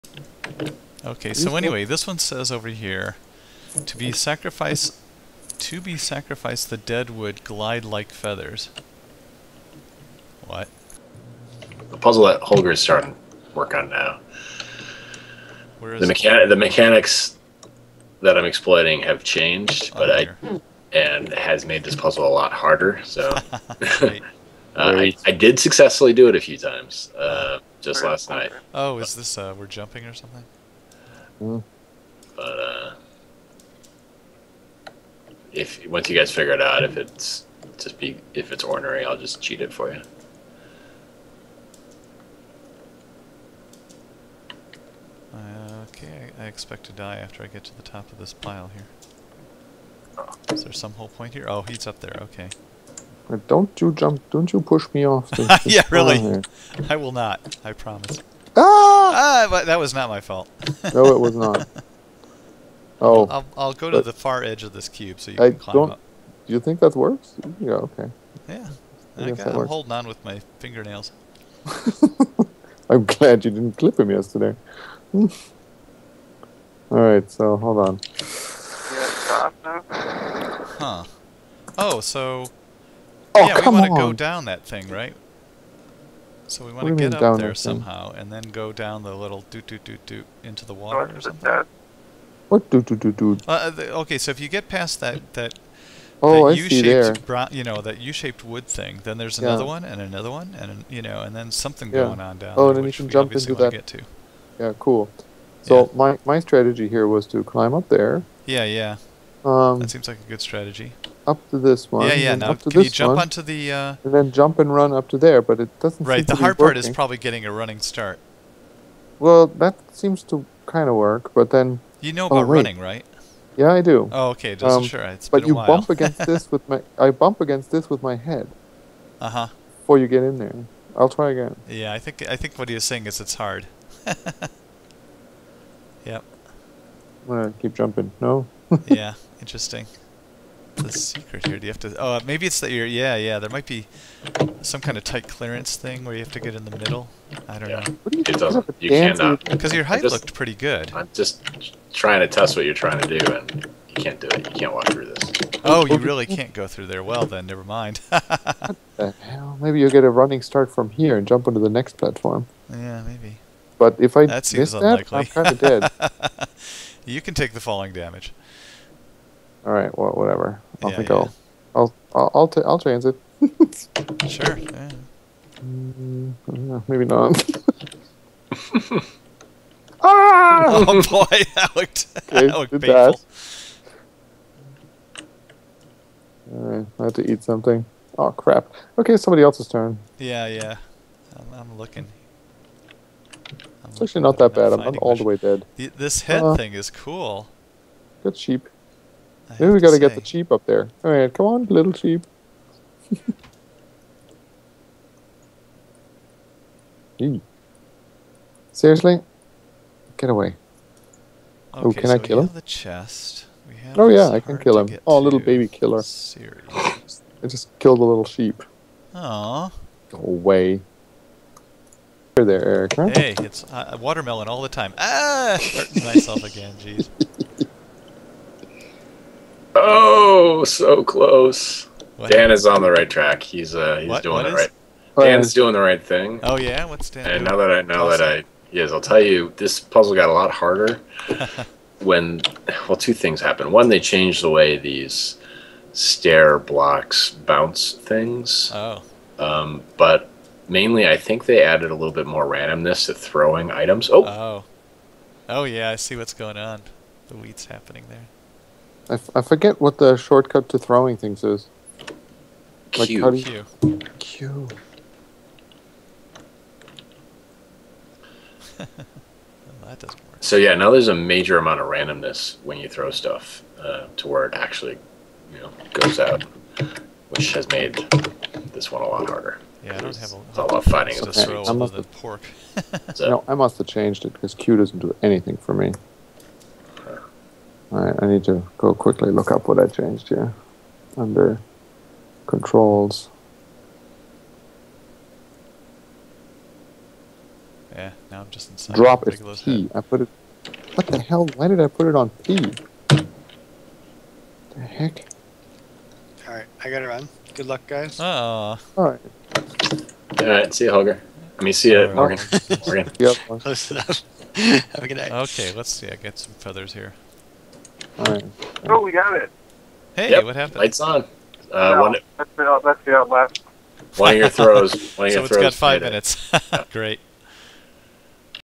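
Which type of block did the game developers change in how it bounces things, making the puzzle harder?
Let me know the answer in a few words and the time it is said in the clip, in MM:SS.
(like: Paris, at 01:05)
Stair blocks, at 04:05.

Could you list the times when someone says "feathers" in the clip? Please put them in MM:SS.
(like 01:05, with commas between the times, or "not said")
00:08, 05:16.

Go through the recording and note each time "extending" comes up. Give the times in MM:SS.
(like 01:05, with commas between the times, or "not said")
not said.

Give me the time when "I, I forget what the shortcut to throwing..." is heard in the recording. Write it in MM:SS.
04:19.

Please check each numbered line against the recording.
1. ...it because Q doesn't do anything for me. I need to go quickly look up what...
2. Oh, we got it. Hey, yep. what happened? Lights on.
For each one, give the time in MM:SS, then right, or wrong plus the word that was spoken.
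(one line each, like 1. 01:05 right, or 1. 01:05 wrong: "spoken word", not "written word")
1. 04:44 right
2. 05:18 right.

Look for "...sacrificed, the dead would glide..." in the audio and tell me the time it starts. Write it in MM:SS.
00:05.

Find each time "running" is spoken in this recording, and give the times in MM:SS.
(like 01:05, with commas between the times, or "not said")
01:57, 02:02, 02:40.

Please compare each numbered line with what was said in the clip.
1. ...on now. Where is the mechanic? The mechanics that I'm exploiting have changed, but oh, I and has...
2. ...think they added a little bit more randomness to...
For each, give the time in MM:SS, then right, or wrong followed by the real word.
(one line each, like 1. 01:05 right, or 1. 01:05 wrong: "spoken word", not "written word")
1. 00:13 right
2. 04:11 right.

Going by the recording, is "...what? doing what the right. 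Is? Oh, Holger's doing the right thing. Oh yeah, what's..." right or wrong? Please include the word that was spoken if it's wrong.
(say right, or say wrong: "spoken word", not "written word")
wrong: "Dan", not "Holger".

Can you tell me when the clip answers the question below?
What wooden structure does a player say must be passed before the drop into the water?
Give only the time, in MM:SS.
01:38.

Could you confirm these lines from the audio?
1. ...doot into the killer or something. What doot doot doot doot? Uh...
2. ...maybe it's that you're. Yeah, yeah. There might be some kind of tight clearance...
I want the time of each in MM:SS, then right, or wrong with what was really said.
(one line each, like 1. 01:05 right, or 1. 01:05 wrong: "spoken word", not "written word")
1. 01:30 wrong: "water", not "killer"
2. 02:22 right.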